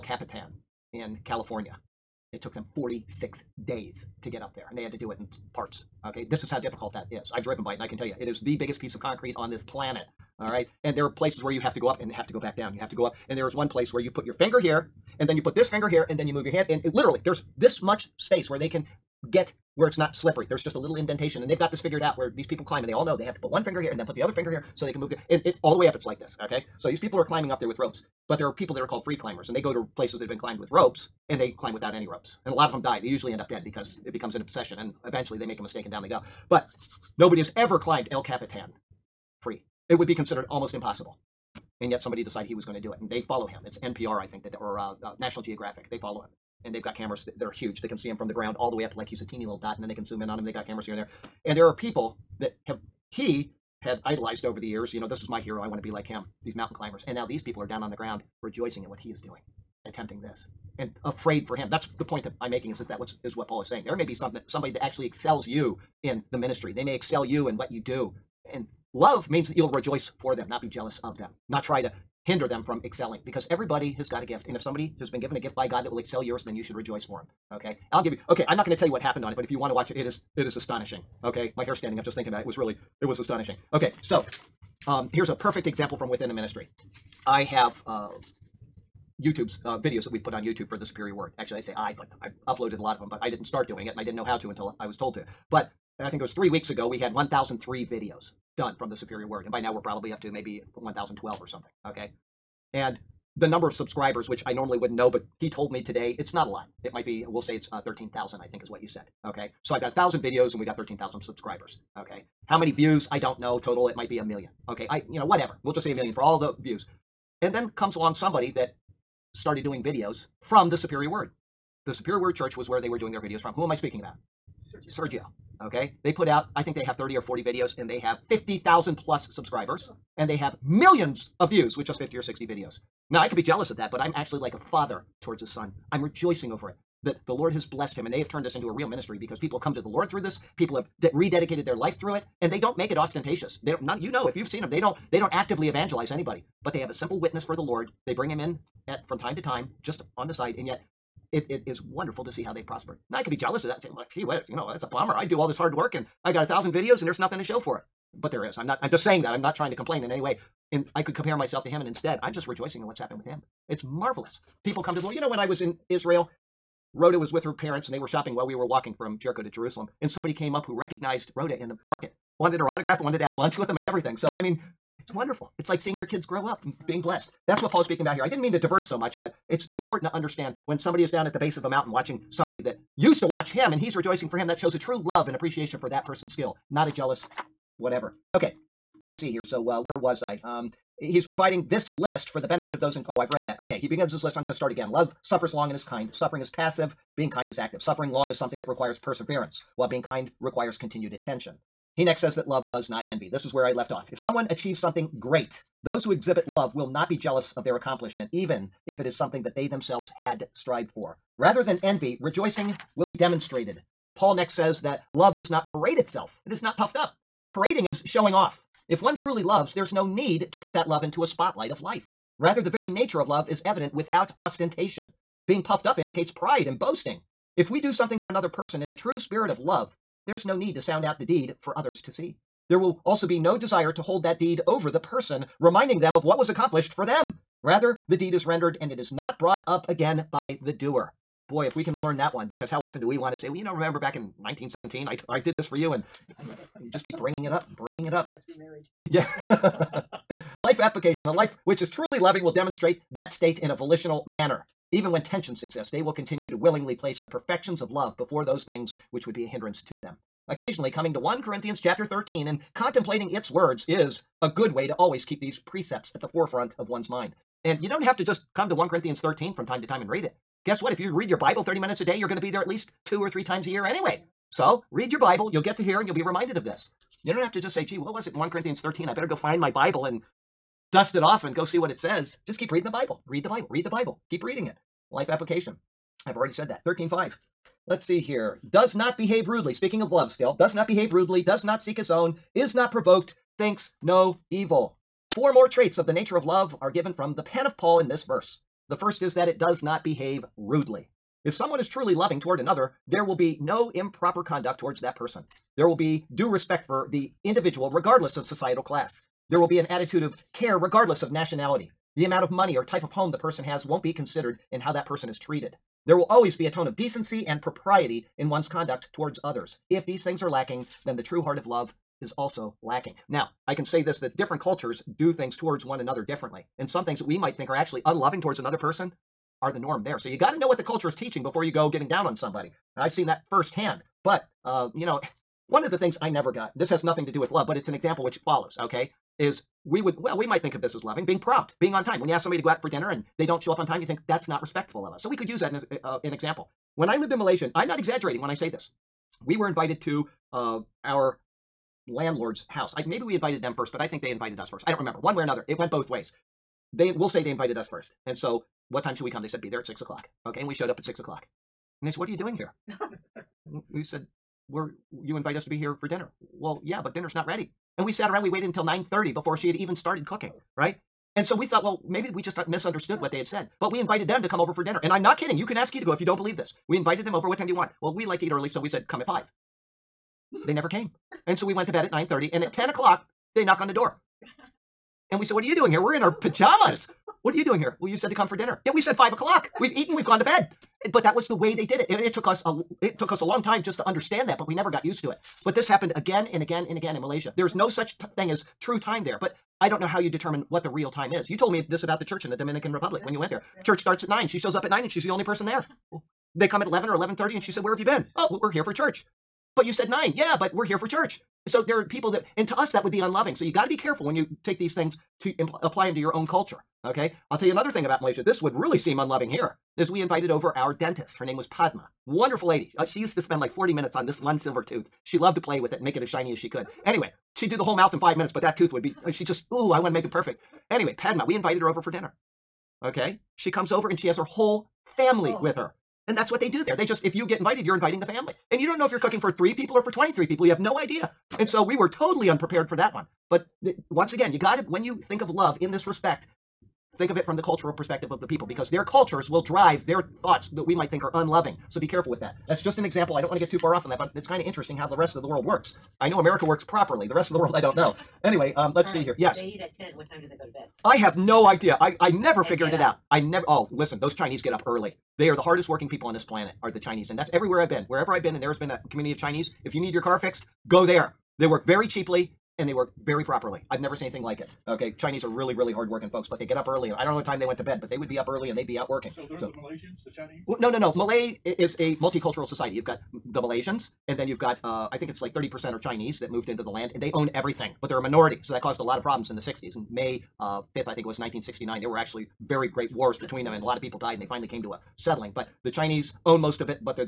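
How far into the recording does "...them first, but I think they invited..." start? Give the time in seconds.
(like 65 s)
353 s.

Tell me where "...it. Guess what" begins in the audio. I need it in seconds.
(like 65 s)
270 s.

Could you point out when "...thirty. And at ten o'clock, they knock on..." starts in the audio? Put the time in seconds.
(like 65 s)
382 s.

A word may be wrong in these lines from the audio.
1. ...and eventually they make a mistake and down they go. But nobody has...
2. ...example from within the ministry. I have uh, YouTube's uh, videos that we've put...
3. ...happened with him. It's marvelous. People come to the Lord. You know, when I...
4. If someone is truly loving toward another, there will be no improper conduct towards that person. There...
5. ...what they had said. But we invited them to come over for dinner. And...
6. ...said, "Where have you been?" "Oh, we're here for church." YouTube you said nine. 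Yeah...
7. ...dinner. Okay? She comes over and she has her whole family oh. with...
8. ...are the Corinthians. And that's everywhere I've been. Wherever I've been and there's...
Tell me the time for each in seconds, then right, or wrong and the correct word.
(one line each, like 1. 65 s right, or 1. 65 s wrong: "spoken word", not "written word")
1. 34 s right
2. 85 s right
3. 162 s right
4. 301 s right
5. 373 s right
6. 407 s wrong: "But", not "YouTube"
7. 432 s right
8. 466 s wrong: "Chinese", not "Corinthians".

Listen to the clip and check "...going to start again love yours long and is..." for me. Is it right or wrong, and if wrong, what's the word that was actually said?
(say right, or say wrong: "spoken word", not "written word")
wrong: "suffers", not "yours".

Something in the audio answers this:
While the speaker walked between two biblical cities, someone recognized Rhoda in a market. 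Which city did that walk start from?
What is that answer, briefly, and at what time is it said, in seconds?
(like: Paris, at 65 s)
Jericho, at 169 s.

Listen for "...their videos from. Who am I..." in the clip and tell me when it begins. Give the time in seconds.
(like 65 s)
123 s.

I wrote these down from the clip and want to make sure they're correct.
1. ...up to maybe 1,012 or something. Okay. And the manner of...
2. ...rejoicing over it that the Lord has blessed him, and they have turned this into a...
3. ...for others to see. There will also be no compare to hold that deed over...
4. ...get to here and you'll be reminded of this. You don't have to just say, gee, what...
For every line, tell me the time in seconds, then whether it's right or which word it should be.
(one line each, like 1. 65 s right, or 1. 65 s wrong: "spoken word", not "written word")
1. 100 s wrong: "number", not "manner"
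2. 136 s right
3. 231 s wrong: "desire", not "compare"
4. 275 s right.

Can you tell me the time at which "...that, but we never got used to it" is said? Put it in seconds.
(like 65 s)
394 s.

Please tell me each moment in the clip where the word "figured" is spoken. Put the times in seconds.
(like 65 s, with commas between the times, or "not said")
21 s, 462 s.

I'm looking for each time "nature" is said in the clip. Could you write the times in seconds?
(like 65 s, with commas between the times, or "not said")
222 s, 296 s.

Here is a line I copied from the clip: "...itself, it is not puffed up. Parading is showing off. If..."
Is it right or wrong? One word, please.
right.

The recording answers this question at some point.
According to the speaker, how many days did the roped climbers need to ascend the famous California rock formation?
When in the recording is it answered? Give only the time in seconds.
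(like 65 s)
2 s.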